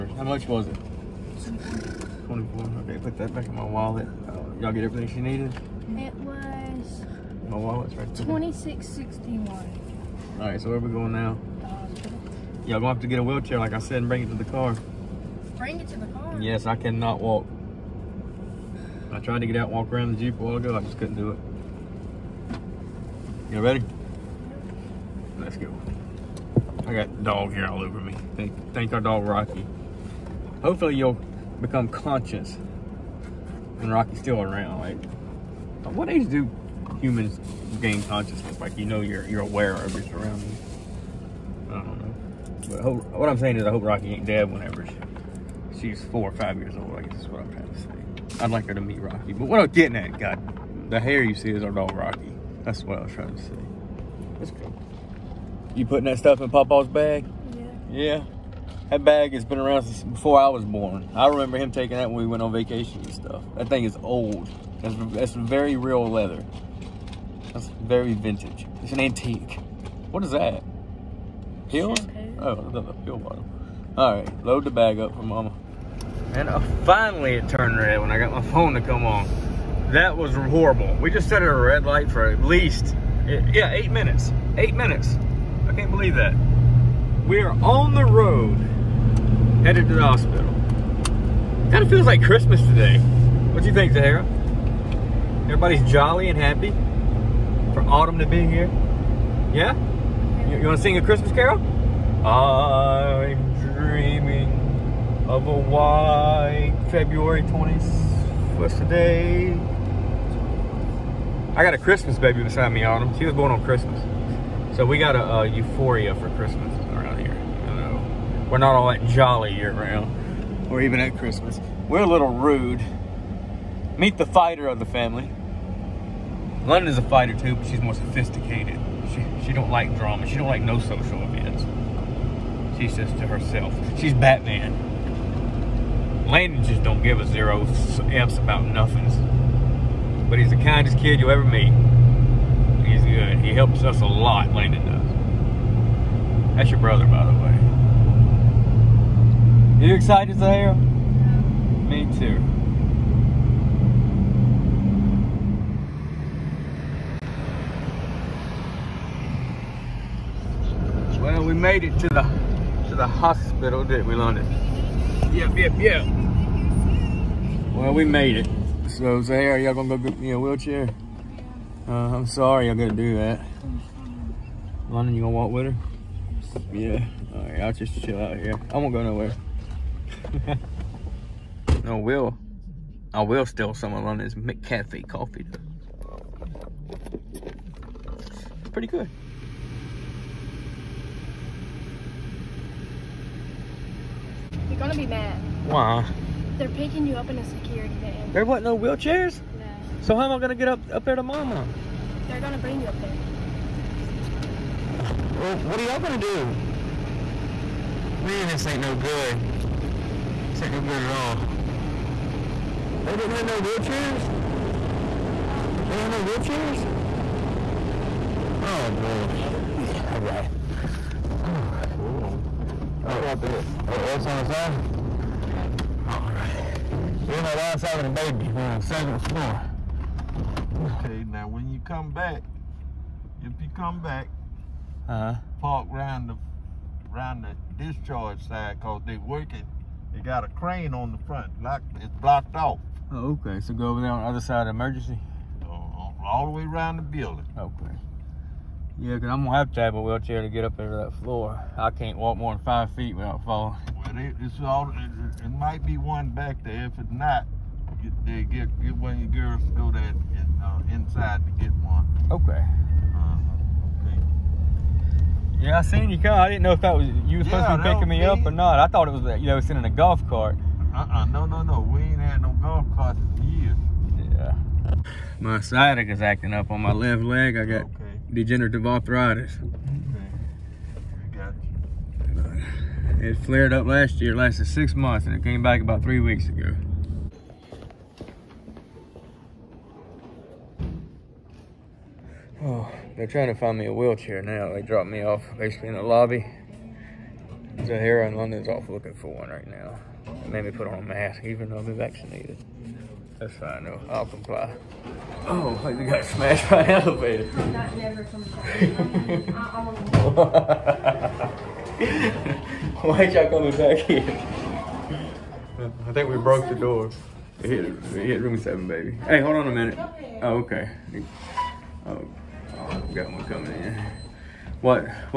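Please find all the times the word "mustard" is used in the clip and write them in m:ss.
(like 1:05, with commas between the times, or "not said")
not said.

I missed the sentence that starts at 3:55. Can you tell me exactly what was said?
park around the around the discharge side because they working.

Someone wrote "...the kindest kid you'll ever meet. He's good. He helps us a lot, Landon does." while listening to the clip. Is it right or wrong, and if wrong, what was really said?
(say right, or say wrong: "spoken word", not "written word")
right.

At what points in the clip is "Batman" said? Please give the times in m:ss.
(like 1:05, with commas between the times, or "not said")
2:14.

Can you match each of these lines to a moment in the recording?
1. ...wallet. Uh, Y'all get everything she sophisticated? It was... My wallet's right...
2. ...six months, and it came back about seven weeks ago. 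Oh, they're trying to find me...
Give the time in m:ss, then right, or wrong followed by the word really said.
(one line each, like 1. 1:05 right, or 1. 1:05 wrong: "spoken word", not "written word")
1. 0:03 wrong: "needed", not "sophisticated"
2. 4:44 wrong: "three", not "seven".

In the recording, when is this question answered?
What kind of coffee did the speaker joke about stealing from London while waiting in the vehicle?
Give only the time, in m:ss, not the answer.
3:04.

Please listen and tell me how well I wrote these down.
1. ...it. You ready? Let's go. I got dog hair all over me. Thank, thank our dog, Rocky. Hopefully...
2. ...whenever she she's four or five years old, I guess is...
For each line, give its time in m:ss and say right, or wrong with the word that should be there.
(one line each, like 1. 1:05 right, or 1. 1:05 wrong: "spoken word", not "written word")
1. 0:21 right
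2. 0:44 right.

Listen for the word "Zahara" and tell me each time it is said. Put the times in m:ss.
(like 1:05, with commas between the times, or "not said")
1:33, 2:30.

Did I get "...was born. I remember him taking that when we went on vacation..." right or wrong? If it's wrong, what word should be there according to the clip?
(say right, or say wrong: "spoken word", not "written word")
right.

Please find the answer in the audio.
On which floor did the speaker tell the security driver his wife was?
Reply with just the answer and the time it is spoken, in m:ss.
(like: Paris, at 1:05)
seventh floor, at 3:48.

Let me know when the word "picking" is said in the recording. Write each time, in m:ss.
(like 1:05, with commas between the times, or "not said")
3:16, 4:27.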